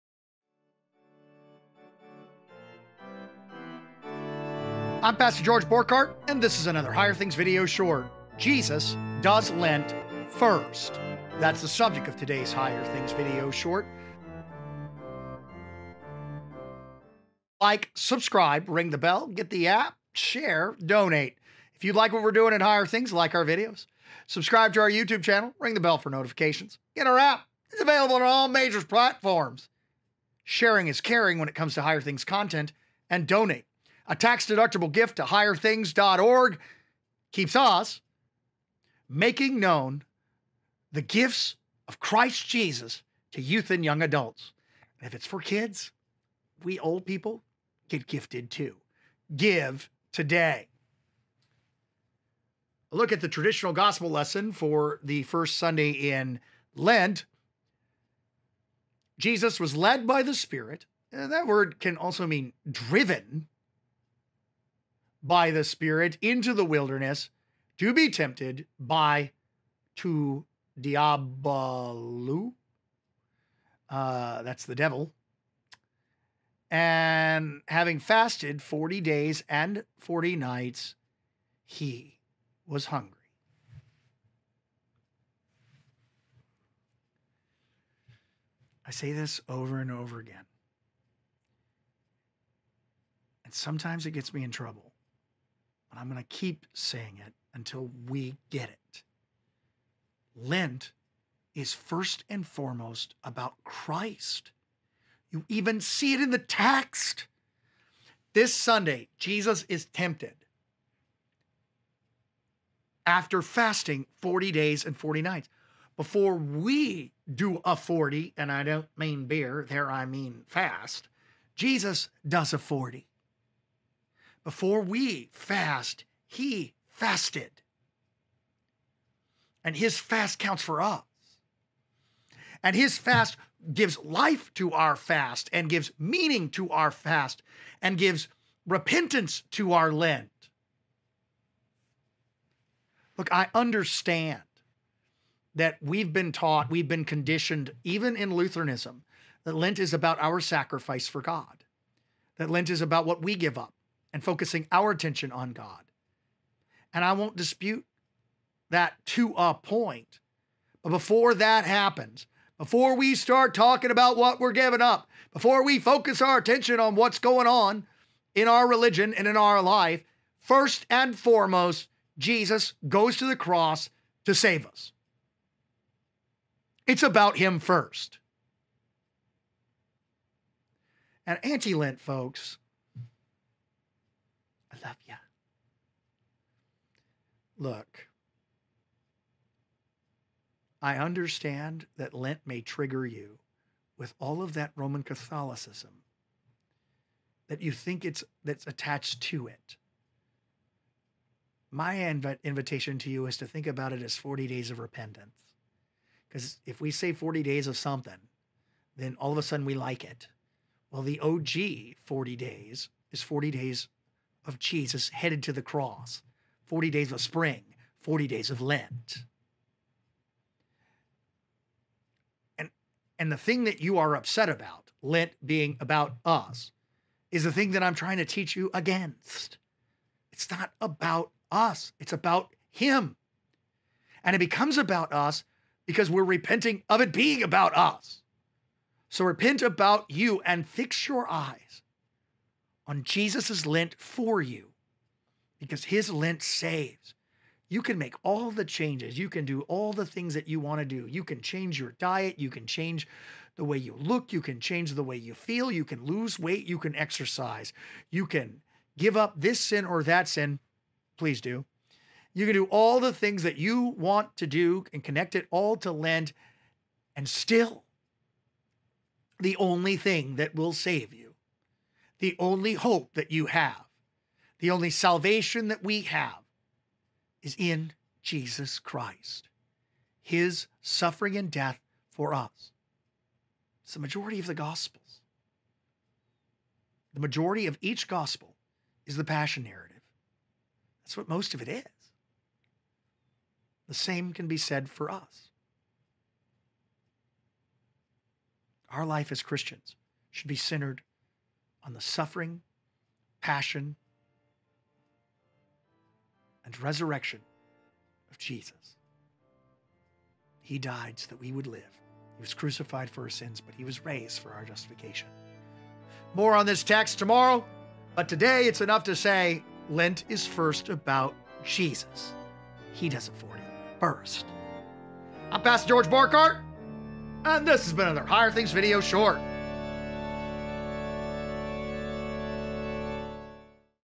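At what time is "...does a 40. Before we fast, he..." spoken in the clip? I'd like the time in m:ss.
2:02.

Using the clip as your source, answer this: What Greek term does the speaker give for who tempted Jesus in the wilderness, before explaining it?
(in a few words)
Diabolu.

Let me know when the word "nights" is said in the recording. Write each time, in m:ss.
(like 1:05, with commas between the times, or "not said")
1:20, 1:55.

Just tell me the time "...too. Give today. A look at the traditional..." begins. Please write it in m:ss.
0:48.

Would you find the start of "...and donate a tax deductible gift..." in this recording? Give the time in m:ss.
0:33.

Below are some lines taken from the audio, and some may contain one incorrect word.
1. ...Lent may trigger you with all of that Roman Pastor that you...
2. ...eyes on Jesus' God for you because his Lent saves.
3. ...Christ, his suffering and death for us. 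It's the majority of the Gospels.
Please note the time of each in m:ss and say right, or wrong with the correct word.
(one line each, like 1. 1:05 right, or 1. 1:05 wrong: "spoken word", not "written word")
1. 3:12 wrong: "Catholicism", not "Pastor"
2. 4:01 wrong: "Lent", not "God"
3. 4:38 right.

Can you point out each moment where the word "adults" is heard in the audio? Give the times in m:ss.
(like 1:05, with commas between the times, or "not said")
0:44.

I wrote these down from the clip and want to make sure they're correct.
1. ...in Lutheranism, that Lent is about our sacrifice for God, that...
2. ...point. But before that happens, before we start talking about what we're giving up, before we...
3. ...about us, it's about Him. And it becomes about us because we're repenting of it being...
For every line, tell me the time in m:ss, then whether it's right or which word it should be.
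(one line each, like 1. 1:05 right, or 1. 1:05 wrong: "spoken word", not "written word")
1. 2:28 right
2. 2:39 right
3. 3:50 right.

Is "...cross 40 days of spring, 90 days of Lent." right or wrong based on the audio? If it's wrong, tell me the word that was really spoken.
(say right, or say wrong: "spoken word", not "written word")
wrong: "40", not "90".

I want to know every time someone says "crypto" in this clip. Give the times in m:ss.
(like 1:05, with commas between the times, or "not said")
not said.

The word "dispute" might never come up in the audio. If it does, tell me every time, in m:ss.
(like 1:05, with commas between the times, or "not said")
2:37.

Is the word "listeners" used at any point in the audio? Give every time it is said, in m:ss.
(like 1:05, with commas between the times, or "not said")
not said.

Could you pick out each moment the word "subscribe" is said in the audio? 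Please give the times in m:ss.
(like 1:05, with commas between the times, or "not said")
0:17, 0:24.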